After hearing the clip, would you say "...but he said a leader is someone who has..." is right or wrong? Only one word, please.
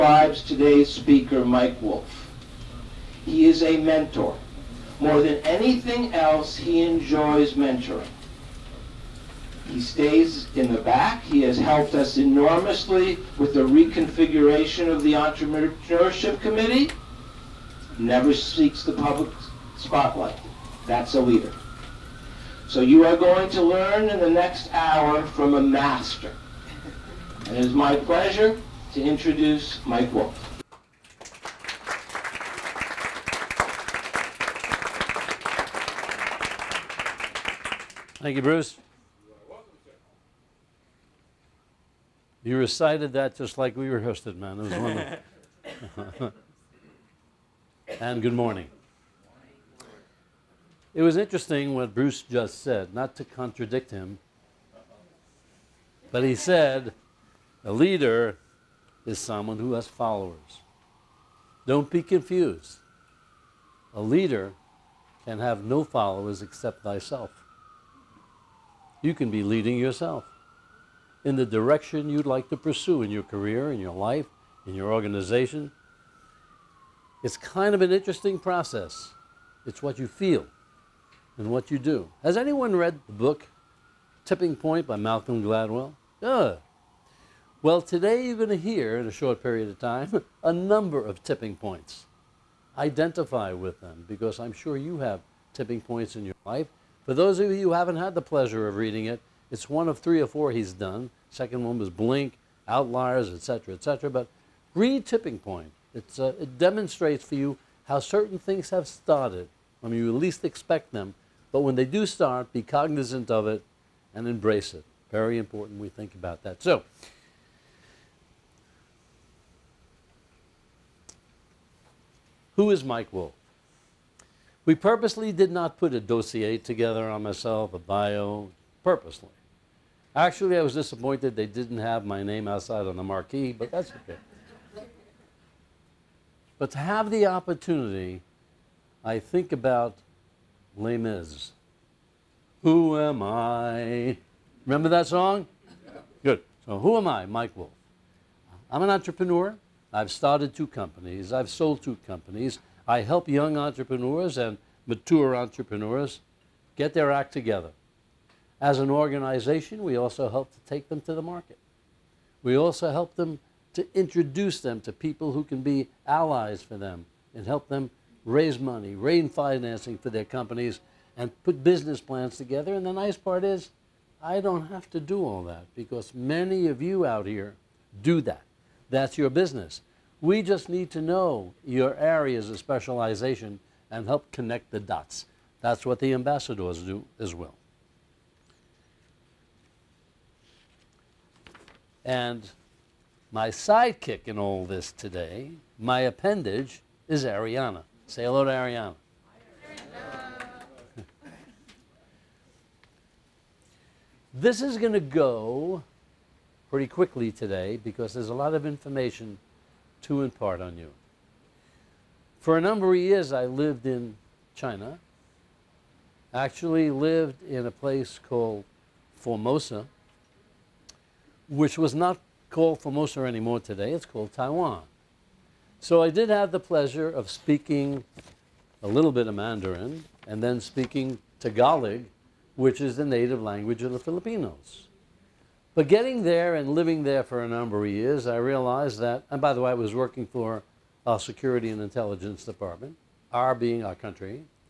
right.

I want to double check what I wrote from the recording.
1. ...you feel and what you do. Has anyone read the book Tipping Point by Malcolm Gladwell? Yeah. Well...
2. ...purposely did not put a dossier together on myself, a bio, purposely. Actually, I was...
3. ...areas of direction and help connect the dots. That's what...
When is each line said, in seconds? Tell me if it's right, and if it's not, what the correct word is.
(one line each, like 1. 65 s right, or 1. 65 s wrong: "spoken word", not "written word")
1. 79 s right
2. 124 s right
3. 181 s wrong: "specialization", not "direction".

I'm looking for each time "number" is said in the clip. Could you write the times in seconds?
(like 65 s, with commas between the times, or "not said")
90 s, 212 s, 237 s.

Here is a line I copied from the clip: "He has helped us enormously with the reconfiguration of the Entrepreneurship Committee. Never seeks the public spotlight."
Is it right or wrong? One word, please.
right.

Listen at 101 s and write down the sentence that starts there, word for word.
Second one was Blink, Outliers, etc., etc.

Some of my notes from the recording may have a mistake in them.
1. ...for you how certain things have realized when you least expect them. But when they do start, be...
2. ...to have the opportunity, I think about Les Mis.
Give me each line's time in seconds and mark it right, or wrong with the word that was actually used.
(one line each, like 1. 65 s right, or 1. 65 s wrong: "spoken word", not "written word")
1. 107 s wrong: "started", not "realized"
2. 136 s right.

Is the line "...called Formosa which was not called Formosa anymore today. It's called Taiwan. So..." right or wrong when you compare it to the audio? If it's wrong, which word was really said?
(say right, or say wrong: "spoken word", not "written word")
right.